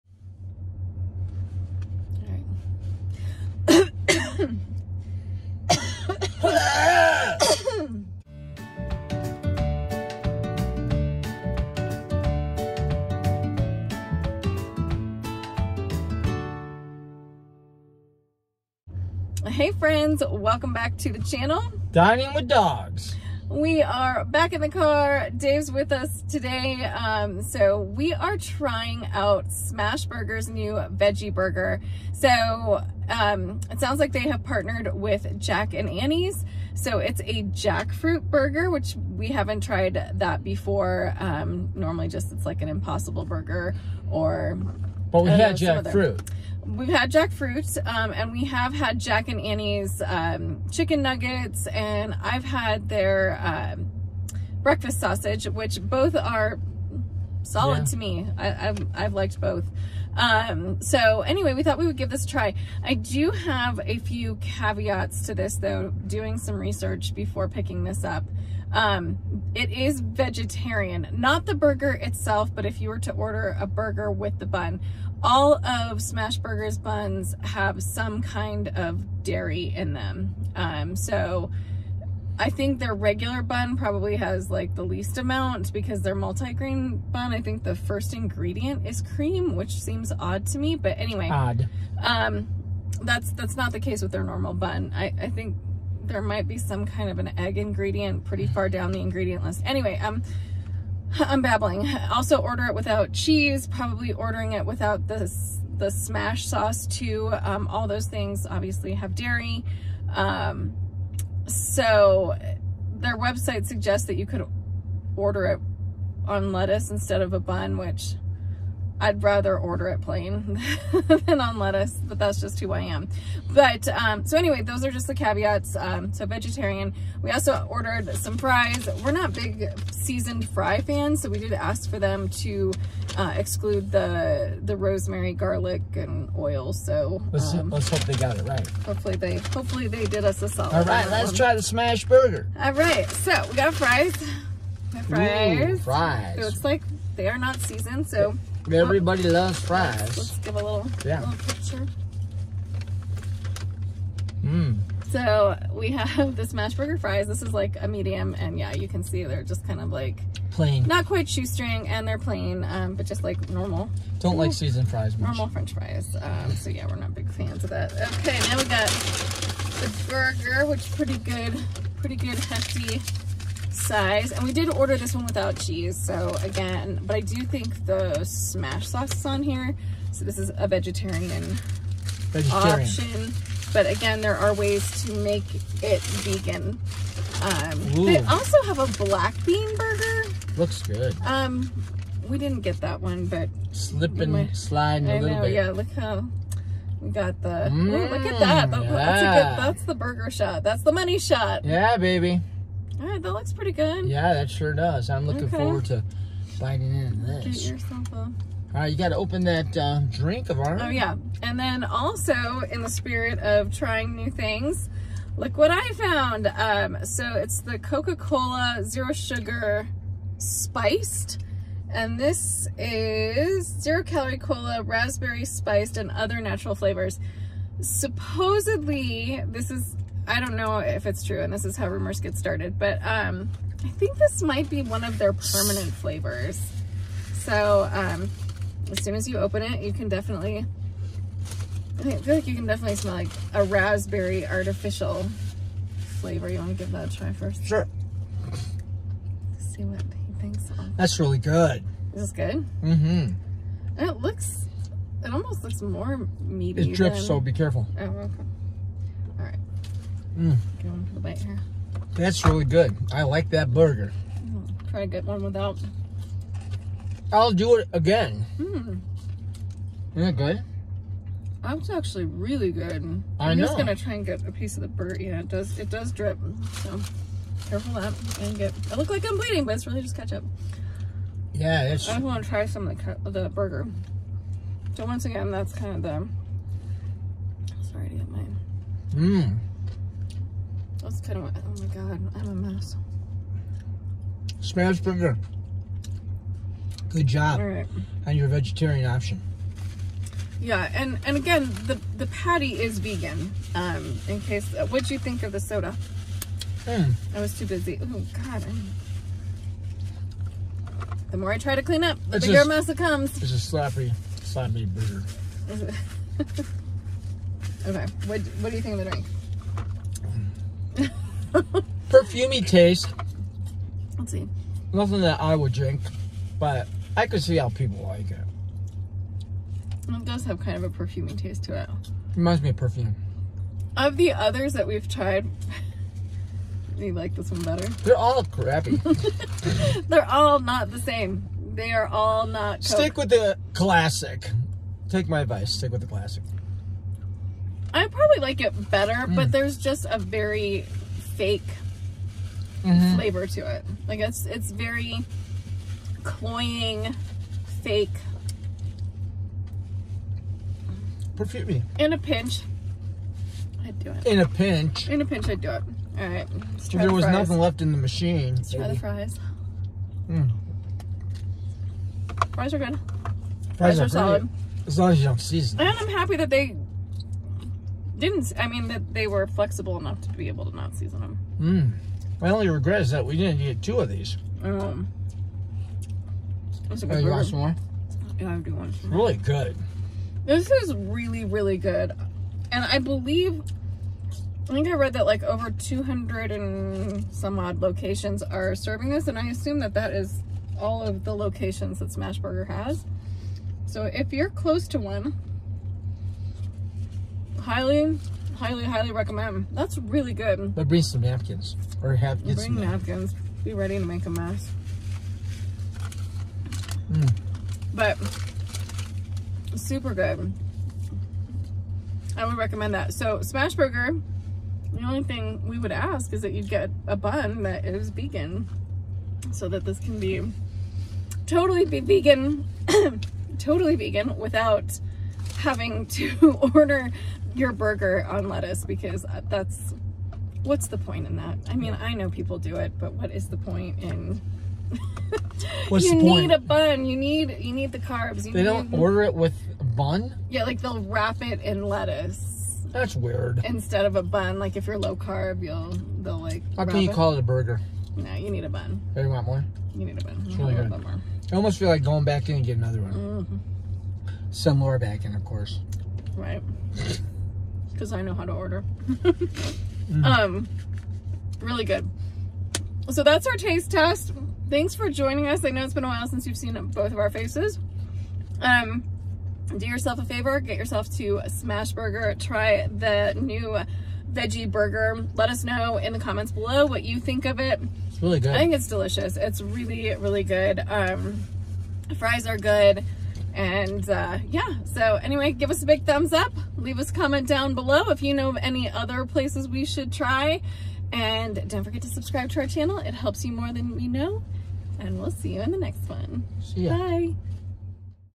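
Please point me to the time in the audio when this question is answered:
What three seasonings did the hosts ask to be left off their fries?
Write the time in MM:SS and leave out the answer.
02:14.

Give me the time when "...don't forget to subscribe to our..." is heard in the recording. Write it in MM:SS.
08:21.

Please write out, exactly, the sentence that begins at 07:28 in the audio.
You they don't order it with bun.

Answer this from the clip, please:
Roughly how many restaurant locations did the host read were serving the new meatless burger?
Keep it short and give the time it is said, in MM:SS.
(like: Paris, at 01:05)
over 200, at 06:35.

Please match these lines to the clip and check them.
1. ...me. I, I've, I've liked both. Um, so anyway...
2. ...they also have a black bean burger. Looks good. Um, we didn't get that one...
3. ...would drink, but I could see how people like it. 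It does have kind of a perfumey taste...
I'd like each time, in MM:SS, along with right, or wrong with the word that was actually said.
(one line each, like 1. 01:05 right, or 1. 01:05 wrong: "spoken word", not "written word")
1. 00:57 right
2. 03:08 right
3. 05:25 right.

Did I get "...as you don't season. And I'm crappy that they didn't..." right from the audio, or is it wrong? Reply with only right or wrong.
wrong.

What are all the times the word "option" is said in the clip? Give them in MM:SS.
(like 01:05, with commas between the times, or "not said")
03:02, 04:59.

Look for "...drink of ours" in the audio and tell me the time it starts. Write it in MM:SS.
03:30.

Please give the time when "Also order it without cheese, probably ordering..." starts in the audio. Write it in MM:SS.
01:42.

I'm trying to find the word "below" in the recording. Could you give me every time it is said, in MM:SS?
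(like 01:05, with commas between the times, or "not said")
08:06, 08:17.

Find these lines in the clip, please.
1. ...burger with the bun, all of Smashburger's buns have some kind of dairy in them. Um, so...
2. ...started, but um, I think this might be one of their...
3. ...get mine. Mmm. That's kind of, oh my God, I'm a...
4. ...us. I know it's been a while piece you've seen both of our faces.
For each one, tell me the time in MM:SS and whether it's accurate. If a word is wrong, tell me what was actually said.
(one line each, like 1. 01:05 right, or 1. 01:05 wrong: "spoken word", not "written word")
1. 01:13 right
2. 03:52 right
3. 04:48 right
4. 07:55 wrong: "since", not "piece".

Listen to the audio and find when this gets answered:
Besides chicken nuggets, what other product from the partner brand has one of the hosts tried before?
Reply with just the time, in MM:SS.
00:54.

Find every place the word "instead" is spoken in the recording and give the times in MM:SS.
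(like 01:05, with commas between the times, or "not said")
01:56, 07:33.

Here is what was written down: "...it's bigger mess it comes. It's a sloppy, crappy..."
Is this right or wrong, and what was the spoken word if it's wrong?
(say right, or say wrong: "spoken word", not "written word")
wrong: "sloppy", not "crappy".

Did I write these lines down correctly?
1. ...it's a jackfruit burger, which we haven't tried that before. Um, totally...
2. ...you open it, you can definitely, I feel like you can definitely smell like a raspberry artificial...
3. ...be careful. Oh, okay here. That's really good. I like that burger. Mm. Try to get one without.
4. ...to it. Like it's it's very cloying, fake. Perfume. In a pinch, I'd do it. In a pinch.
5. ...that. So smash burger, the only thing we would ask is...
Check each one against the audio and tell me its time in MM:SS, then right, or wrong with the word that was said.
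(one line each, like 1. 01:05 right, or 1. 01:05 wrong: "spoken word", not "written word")
1. 00:36 wrong: "normally", not "totally"
2. 03:59 right
3. 04:17 right
4. 05:53 right
5. 07:02 right.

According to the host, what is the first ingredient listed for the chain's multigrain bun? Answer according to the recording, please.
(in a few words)
cream.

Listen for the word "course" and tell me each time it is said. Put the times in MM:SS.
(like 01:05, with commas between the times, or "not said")
07:45.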